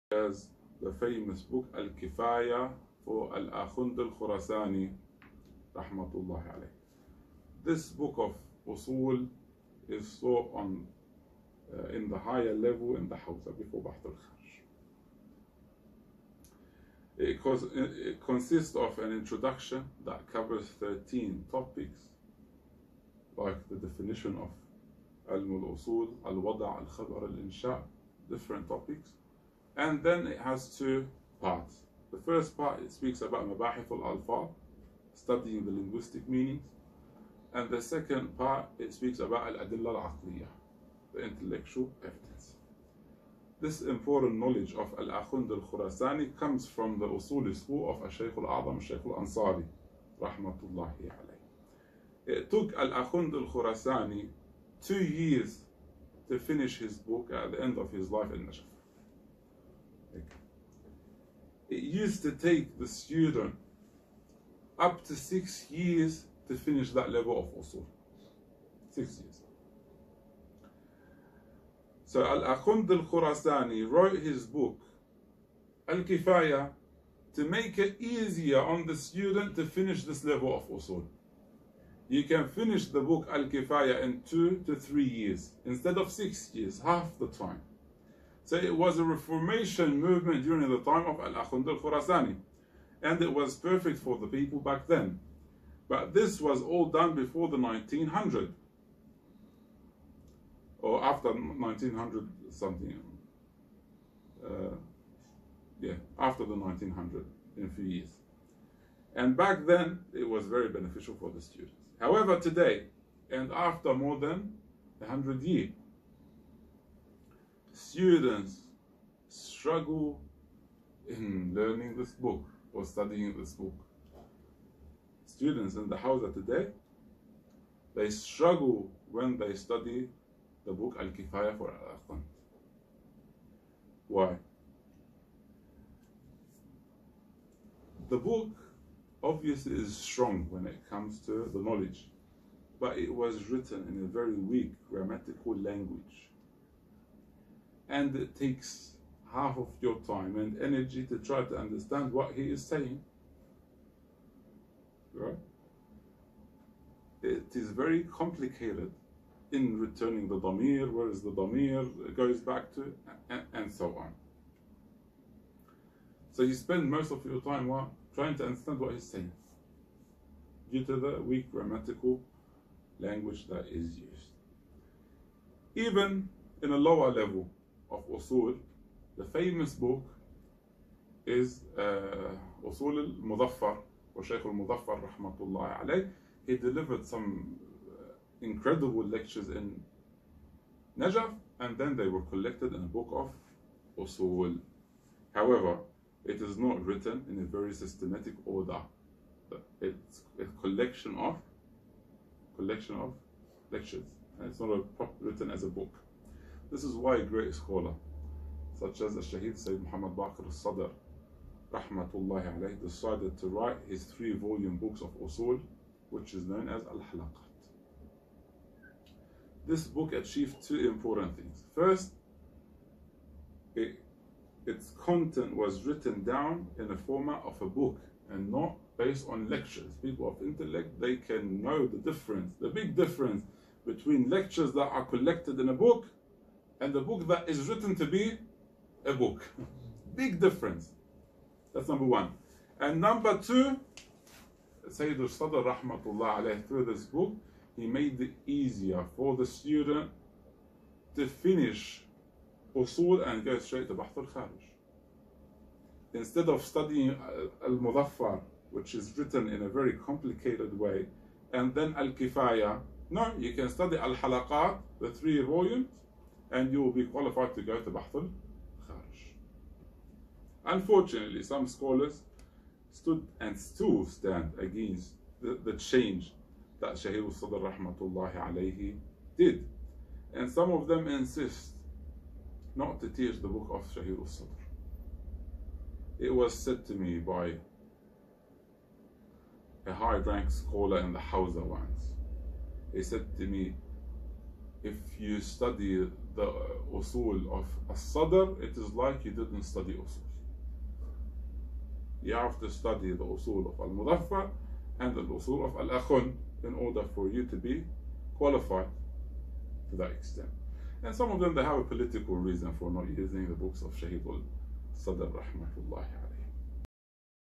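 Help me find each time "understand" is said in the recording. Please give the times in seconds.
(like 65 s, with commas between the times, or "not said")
151 s, 168 s.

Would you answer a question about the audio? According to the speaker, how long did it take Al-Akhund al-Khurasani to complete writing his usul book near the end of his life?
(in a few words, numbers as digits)
2 years.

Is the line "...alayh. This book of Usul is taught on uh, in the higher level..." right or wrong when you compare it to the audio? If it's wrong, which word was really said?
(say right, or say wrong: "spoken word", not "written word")
right.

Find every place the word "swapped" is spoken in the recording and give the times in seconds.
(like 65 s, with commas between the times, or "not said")
not said.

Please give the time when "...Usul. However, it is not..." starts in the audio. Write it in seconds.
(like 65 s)
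194 s.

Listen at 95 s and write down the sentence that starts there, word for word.
But this was all done before the 1900.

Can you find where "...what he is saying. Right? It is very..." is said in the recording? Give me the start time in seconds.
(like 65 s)
152 s.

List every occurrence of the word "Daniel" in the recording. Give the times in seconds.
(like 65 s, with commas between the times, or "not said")
not said.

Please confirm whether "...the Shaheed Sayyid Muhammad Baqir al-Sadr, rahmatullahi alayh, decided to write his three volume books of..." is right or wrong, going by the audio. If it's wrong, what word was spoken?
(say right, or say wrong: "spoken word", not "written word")
right.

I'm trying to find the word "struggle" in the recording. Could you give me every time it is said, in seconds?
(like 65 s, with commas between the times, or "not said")
119 s, 128 s.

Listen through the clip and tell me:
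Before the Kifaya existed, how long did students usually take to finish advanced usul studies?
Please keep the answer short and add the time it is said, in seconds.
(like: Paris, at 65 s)
6 years, at 64 s.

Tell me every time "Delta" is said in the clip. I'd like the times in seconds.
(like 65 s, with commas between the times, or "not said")
not said.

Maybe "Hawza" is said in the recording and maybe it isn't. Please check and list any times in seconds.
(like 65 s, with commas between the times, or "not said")
13 s, 125 s, 291 s.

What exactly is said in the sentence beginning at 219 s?
This book achieved two important things.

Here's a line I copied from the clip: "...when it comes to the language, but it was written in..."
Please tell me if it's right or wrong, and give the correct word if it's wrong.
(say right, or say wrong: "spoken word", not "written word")
wrong: "knowledge", not "language".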